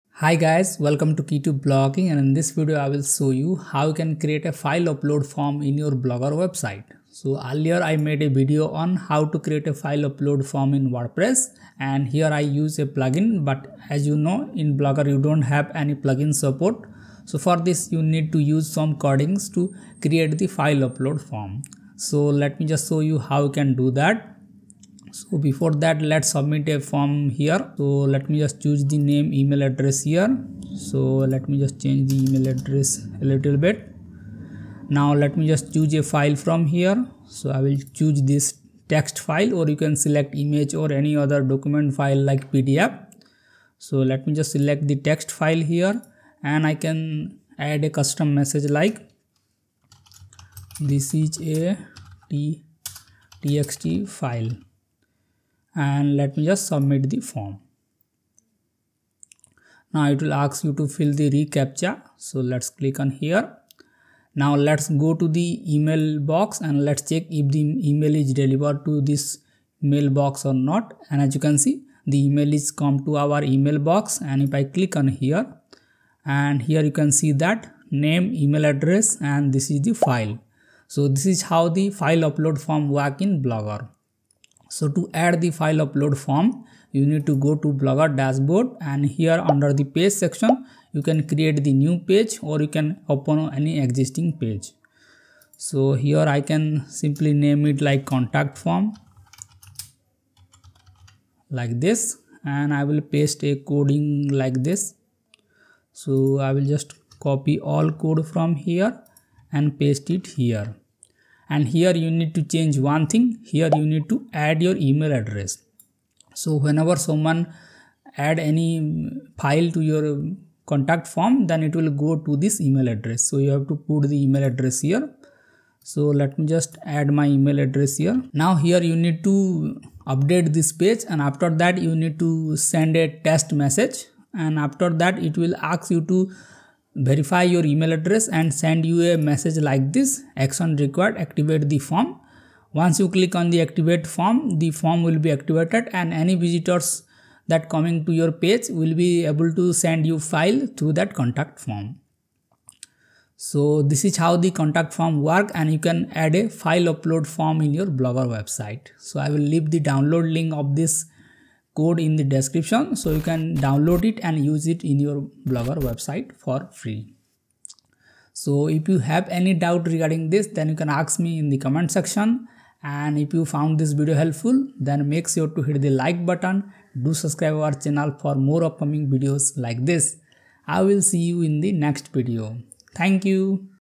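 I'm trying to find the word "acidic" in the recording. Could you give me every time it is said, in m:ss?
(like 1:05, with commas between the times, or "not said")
not said.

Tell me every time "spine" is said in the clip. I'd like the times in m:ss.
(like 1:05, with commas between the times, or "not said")
not said.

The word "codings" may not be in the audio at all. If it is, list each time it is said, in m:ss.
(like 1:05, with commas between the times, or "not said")
0:18, 1:43.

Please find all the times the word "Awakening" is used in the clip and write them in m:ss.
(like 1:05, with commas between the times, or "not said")
not said.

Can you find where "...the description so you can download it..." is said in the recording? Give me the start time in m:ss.
2:42.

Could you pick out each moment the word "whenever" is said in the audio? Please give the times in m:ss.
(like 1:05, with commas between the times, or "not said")
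1:56.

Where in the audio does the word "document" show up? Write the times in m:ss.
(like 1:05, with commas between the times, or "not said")
0:41.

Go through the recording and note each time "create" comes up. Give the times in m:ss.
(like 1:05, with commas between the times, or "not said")
0:04, 0:09, 0:20, 1:31.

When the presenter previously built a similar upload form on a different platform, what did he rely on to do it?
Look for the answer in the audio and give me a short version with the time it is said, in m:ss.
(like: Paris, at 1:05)
a plugin, at 0:12.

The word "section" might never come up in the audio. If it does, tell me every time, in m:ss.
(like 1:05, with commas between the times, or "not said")
1:30, 2:51.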